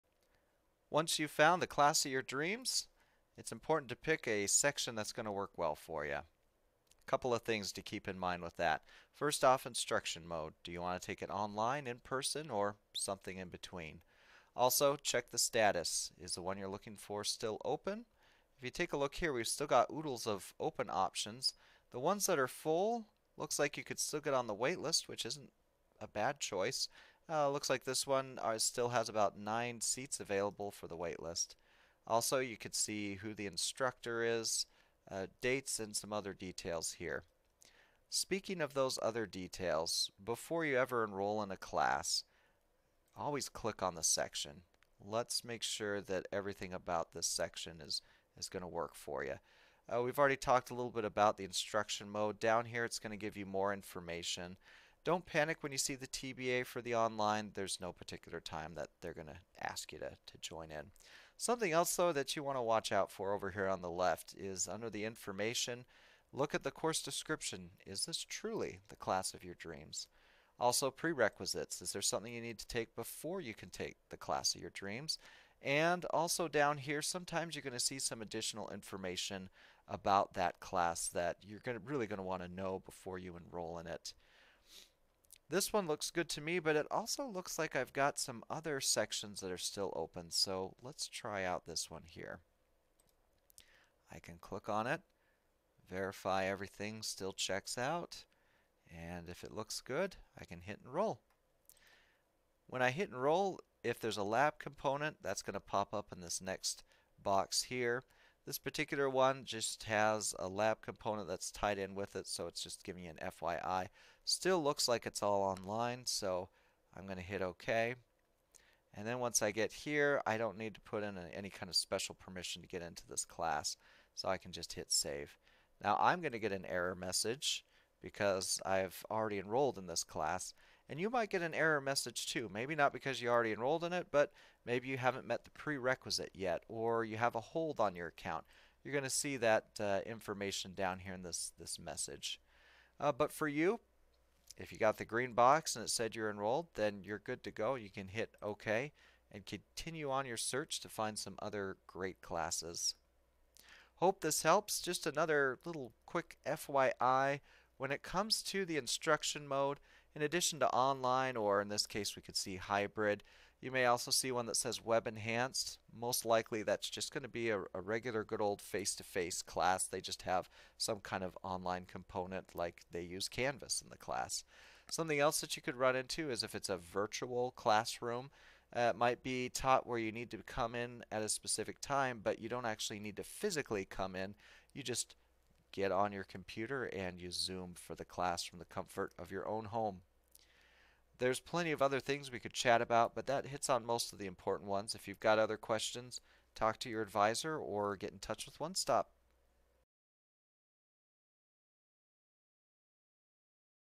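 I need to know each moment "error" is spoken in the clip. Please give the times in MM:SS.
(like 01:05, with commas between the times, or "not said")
02:06, 02:11.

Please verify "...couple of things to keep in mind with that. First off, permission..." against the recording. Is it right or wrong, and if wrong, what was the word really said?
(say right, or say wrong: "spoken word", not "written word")
wrong: "instruction", not "permission".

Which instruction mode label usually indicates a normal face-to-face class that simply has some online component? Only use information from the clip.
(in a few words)
Web Enhanced.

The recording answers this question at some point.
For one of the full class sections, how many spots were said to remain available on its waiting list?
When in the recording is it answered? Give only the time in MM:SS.
00:29.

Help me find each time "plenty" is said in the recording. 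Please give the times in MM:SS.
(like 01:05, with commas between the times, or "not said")
03:11.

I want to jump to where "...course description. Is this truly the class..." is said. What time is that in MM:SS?
01:06.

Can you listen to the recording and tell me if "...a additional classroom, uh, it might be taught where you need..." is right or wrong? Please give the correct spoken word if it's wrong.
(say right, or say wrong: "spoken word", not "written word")
wrong: "virtual", not "additional".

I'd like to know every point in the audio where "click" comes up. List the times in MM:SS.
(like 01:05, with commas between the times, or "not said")
00:43, 01:34.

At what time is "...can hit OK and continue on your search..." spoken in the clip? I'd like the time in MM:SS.
02:27.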